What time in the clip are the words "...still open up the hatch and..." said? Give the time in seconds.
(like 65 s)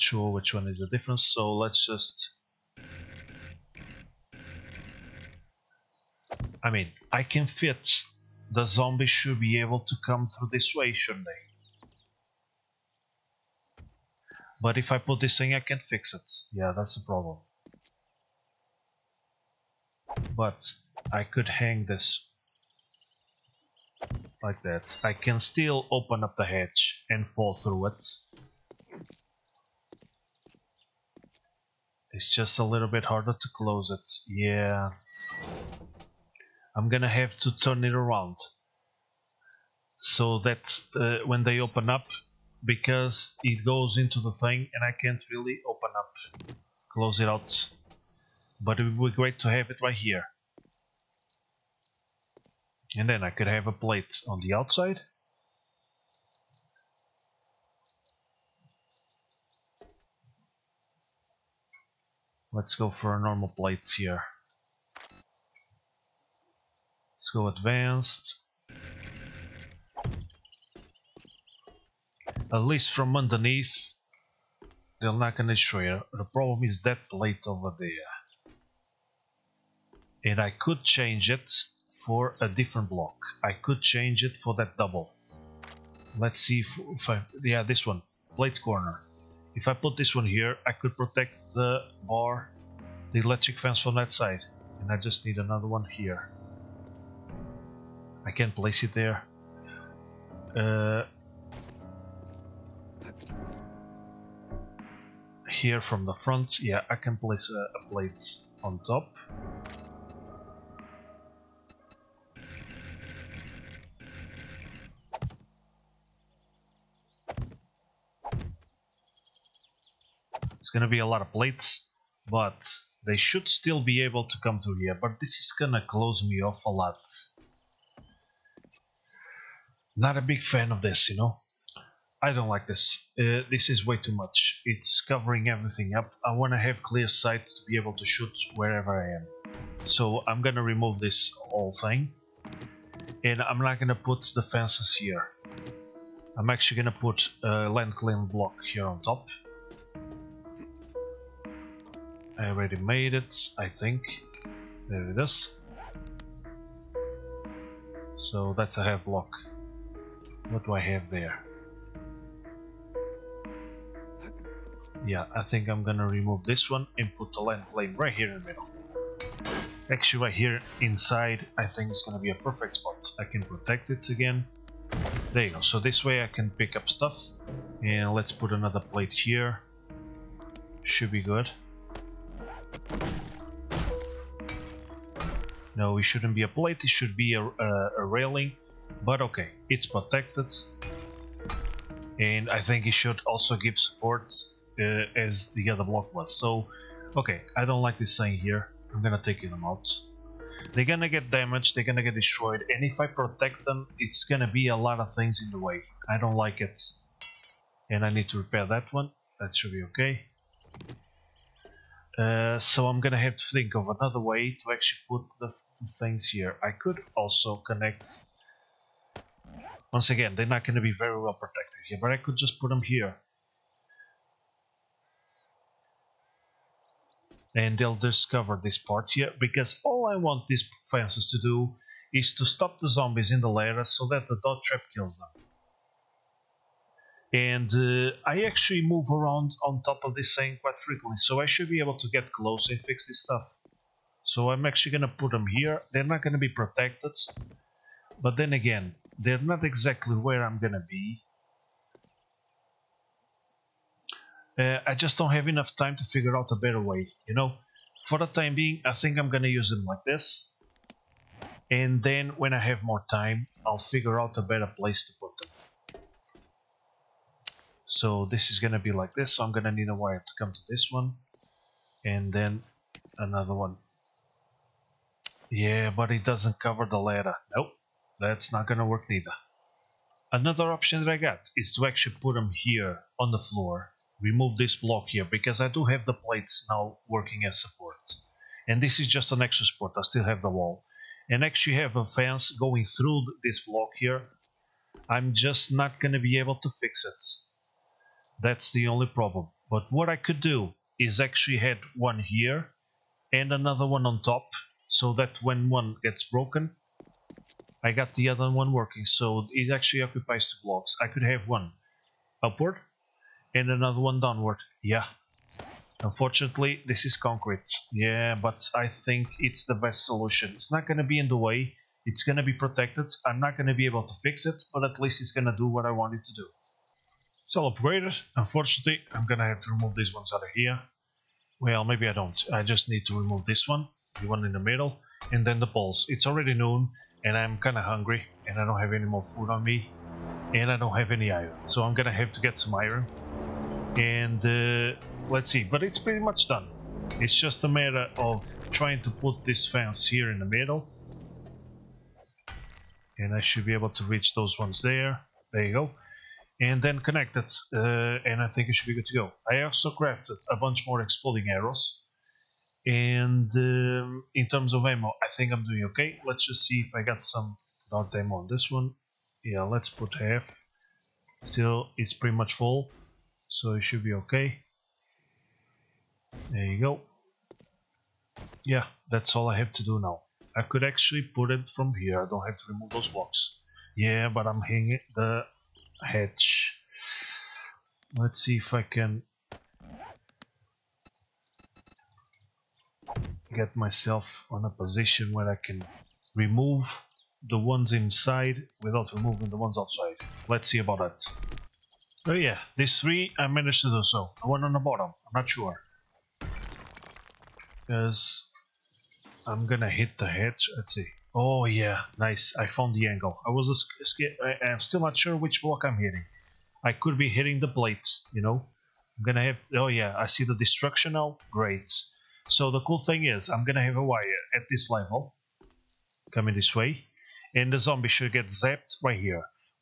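25 s.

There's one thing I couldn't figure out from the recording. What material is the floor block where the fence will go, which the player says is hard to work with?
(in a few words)
Concrete.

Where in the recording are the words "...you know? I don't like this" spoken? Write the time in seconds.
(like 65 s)
131 s.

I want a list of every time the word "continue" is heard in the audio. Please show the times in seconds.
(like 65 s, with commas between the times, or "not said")
not said.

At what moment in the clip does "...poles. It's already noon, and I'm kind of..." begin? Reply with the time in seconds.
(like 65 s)
335 s.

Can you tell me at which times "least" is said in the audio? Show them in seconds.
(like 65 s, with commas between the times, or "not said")
72 s, 324 s.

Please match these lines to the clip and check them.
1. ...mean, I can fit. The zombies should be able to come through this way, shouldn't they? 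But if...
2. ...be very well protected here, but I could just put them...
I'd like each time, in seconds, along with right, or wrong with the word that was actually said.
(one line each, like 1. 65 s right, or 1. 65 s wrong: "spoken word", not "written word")
1. 6 s right
2. 220 s right.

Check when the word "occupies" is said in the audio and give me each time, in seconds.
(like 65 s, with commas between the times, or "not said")
310 s.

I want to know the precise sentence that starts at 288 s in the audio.
And this is just an extra support, I still have the wall.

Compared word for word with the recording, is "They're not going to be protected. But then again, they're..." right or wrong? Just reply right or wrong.
right.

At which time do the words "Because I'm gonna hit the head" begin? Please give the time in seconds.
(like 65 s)
407 s.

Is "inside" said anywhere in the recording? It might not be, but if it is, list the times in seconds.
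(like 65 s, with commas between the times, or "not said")
170 s, 397 s.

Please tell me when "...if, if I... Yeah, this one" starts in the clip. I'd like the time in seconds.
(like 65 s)
86 s.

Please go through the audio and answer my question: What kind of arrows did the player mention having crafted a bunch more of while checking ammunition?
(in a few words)
Exploding arrows.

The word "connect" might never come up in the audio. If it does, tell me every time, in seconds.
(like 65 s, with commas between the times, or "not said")
217 s, 356 s.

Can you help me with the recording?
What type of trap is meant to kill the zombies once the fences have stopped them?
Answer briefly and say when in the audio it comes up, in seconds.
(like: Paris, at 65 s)
Dart trap, at 234 s.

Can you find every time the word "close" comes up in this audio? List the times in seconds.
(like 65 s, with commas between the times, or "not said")
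33 s, 46 s, 125 s, 242 s.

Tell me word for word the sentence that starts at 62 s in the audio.
Let's go for a normal plate here.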